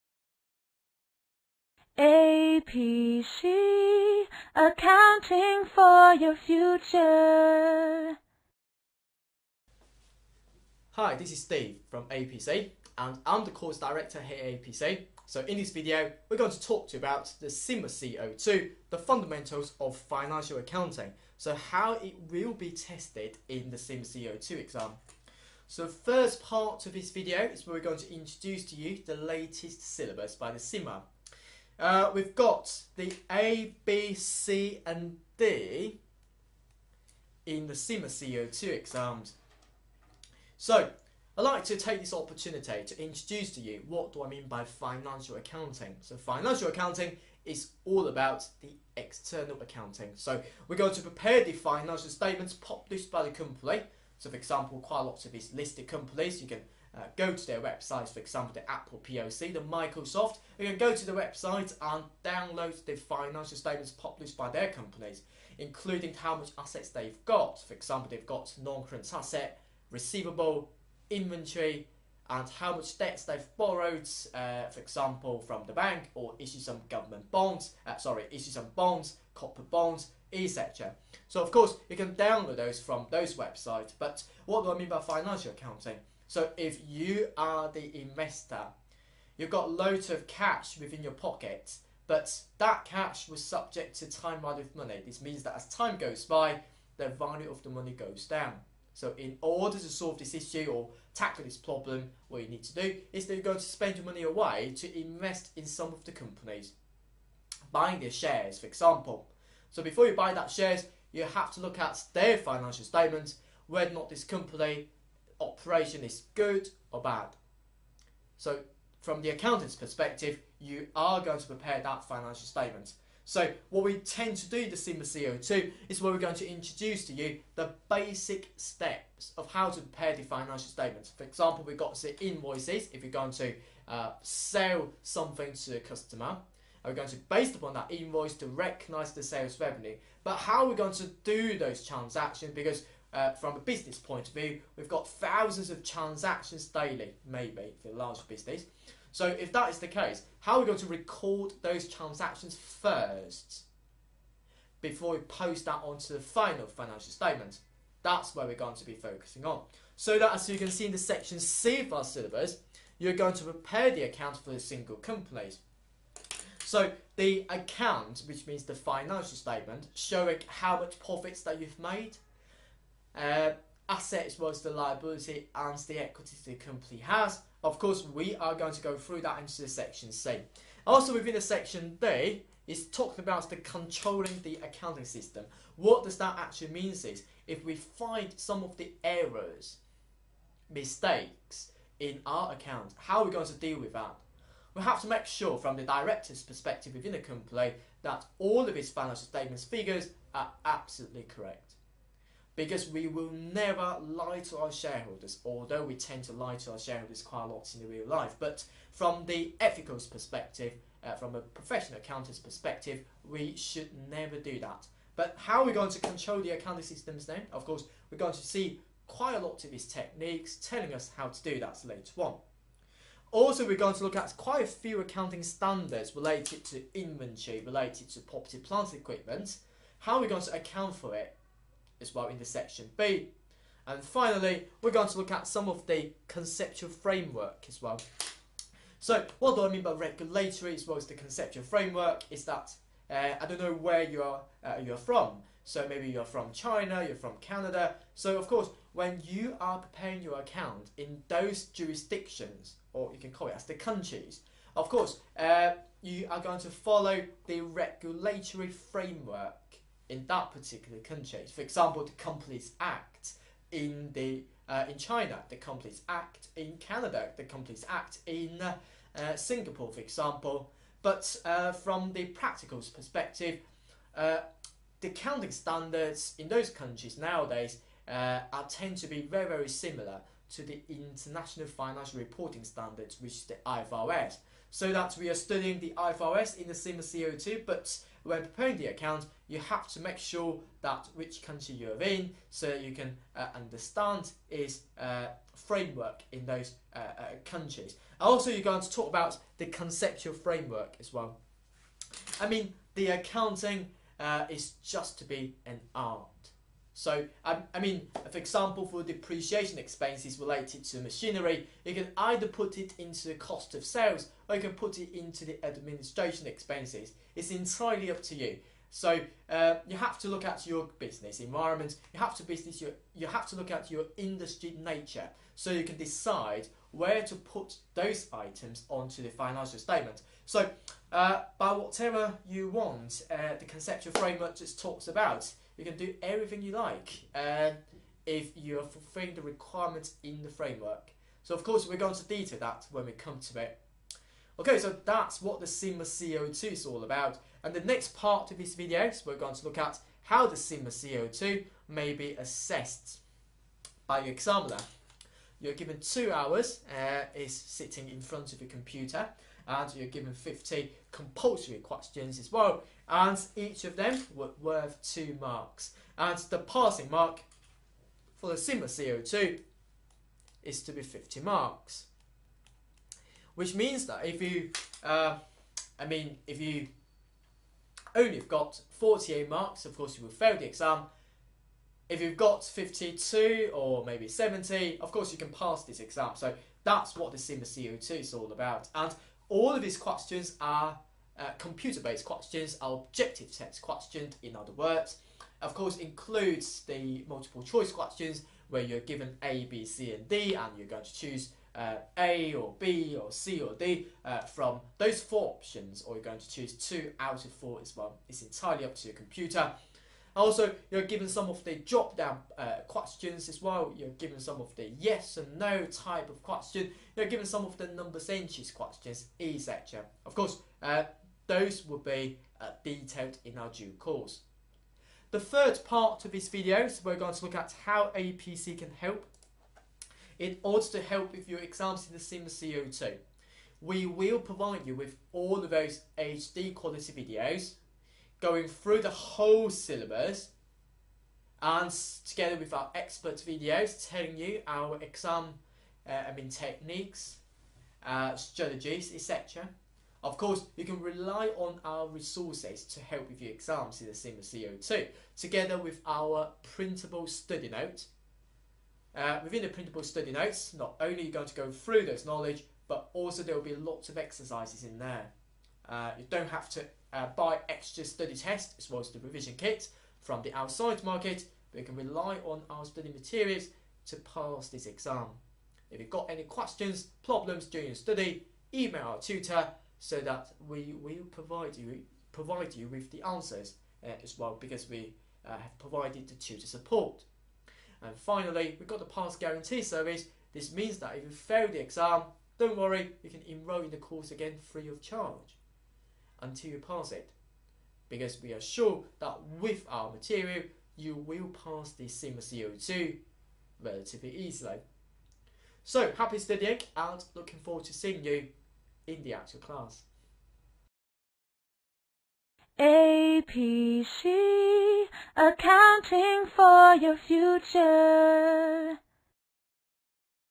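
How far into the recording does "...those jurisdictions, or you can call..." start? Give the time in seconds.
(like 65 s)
251 s.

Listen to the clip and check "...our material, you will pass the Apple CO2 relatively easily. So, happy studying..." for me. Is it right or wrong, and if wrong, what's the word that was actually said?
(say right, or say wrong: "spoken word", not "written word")
wrong: "CIMA", not "Apple".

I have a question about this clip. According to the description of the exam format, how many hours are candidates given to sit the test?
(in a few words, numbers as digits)
2.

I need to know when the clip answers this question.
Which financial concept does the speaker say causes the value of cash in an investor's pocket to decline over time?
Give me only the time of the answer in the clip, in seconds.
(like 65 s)
94 s.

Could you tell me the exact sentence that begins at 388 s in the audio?
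And all of these questions are uh, computer-based questions, are objective test questions, in other words.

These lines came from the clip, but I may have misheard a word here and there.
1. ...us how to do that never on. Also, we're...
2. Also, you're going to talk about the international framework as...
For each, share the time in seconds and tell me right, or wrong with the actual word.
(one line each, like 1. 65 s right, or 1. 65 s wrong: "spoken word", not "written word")
1. 220 s wrong: "later", not "never"
2. 298 s wrong: "conceptual", not "international".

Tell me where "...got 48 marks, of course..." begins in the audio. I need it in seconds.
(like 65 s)
378 s.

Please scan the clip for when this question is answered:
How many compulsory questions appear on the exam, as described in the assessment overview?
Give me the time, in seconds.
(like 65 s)
360 s.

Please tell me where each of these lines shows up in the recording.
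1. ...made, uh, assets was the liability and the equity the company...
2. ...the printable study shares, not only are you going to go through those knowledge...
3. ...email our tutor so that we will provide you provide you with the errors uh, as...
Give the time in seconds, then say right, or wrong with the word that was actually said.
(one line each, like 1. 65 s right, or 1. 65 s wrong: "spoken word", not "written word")
1. 171 s right
2. 459 s wrong: "notes", not "shares"
3. 478 s wrong: "answers", not "errors".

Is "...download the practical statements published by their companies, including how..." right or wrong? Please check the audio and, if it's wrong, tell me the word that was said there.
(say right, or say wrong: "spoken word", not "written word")
wrong: "financial", not "practical".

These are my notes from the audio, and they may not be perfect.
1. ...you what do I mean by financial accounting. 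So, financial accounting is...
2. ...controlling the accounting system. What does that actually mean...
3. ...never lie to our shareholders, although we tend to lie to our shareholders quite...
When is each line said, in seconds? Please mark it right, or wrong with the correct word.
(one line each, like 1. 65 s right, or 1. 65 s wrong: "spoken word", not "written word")
1. 43 s right
2. 183 s right
3. 203 s right.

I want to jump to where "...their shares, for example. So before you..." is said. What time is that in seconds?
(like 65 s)
107 s.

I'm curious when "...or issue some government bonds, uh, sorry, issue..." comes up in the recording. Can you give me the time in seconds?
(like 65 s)
76 s.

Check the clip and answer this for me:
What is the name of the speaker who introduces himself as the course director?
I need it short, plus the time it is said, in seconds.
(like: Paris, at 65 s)
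Steve, at 11 s.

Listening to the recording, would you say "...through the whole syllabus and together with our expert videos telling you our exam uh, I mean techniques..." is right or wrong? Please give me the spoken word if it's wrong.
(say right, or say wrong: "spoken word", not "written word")
right.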